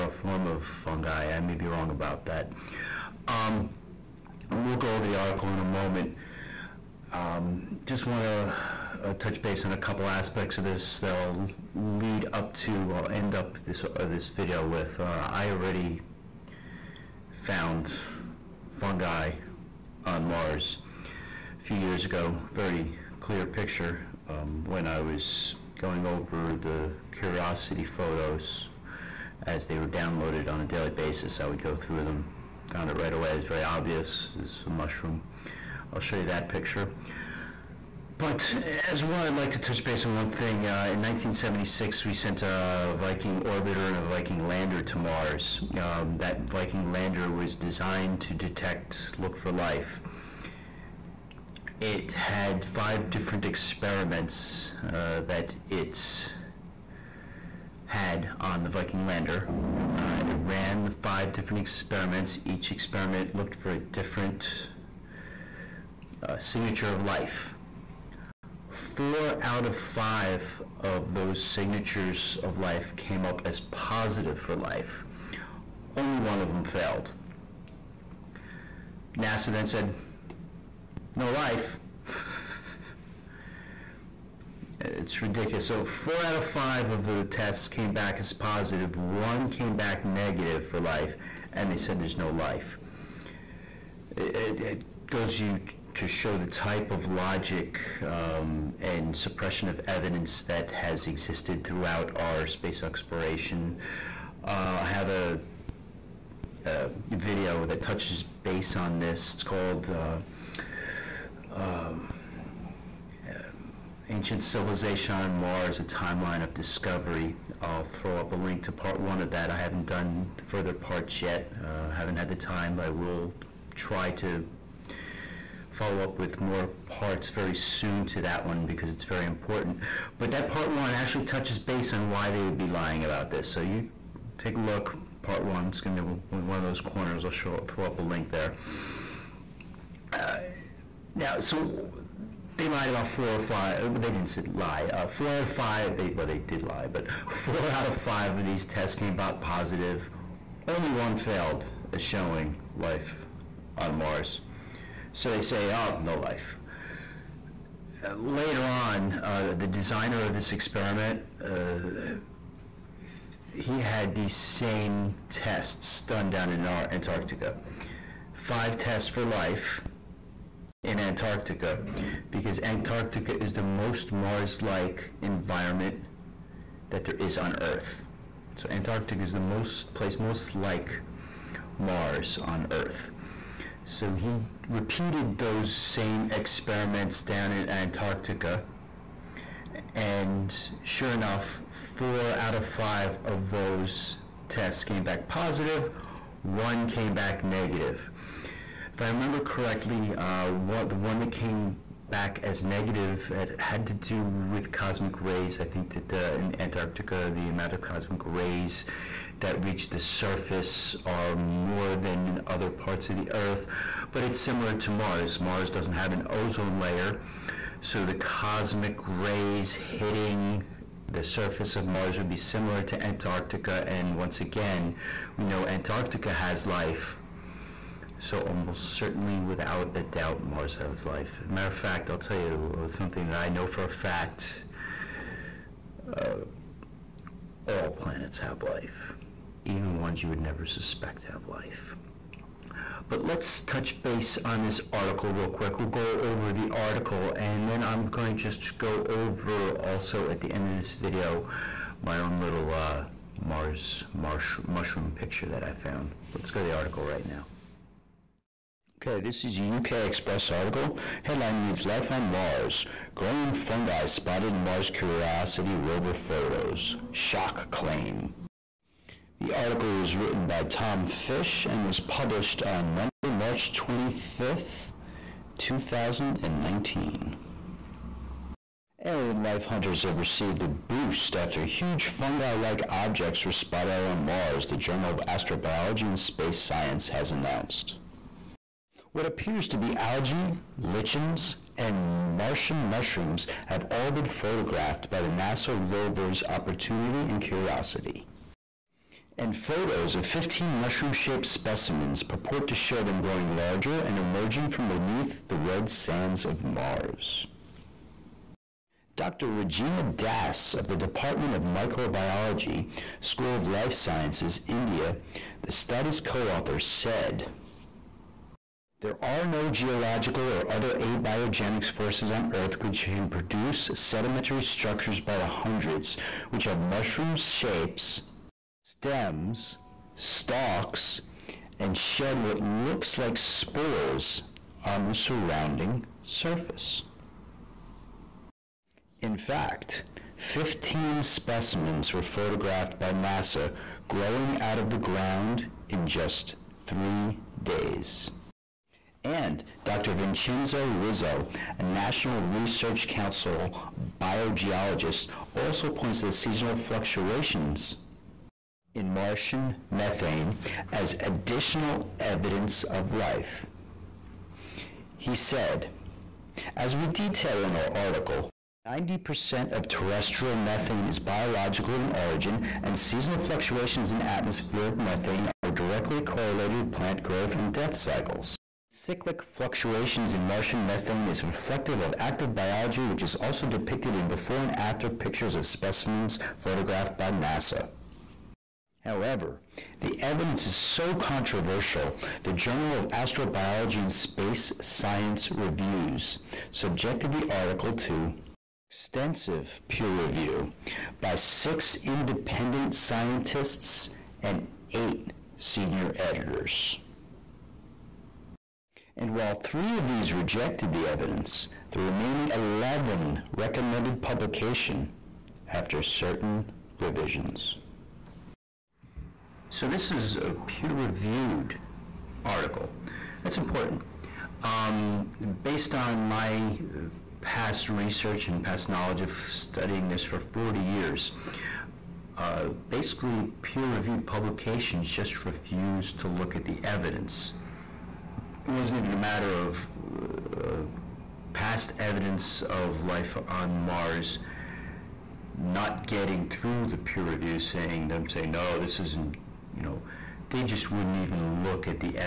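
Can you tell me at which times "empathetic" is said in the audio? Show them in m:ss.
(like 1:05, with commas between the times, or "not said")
not said.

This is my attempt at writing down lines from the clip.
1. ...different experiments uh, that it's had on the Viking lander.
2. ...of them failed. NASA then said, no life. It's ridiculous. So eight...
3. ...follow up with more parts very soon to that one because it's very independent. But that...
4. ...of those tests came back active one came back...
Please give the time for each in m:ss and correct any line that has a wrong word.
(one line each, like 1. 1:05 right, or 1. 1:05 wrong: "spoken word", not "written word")
1. 0:53 right
2. 1:16 wrong: "four", not "eight"
3. 2:05 wrong: "important", not "independent"
4. 3:13 wrong: "positive", not "active".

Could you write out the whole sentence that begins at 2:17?
I'll show, throw up a link there.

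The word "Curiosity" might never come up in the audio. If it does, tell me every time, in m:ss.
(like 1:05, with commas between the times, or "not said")
0:27, 4:24, 4:57.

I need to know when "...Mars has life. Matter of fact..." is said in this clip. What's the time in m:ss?
3:50.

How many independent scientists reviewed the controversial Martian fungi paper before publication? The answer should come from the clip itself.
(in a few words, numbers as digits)
6.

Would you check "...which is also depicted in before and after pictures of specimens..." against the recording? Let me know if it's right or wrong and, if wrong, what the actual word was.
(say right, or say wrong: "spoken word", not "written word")
right.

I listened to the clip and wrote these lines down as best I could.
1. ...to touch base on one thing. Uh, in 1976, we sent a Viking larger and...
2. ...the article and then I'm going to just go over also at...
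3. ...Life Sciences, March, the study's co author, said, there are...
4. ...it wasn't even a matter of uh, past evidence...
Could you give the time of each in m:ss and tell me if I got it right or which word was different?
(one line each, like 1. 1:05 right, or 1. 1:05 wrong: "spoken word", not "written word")
1. 0:39 wrong: "orbiter", not "larger"
2. 4:06 right
3. 5:13 wrong: "India", not "March"
4. 7:18 right.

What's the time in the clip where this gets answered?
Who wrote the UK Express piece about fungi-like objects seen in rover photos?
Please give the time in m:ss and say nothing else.
4:30.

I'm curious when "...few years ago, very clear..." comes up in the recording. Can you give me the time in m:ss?
0:21.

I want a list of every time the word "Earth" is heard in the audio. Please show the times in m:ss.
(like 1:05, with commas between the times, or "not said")
2:57, 3:02, 3:33, 5:22.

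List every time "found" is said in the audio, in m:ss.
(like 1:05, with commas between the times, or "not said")
0:17, 0:32, 4:15.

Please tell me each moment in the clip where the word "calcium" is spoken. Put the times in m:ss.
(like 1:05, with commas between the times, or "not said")
not said.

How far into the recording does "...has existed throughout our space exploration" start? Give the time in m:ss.
1:40.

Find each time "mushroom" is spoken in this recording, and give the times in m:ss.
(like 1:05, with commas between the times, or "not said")
0:34, 4:14, 4:52, 5:00, 5:26.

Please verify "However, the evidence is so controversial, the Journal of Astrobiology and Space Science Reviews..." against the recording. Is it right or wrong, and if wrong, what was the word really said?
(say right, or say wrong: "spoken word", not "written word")
right.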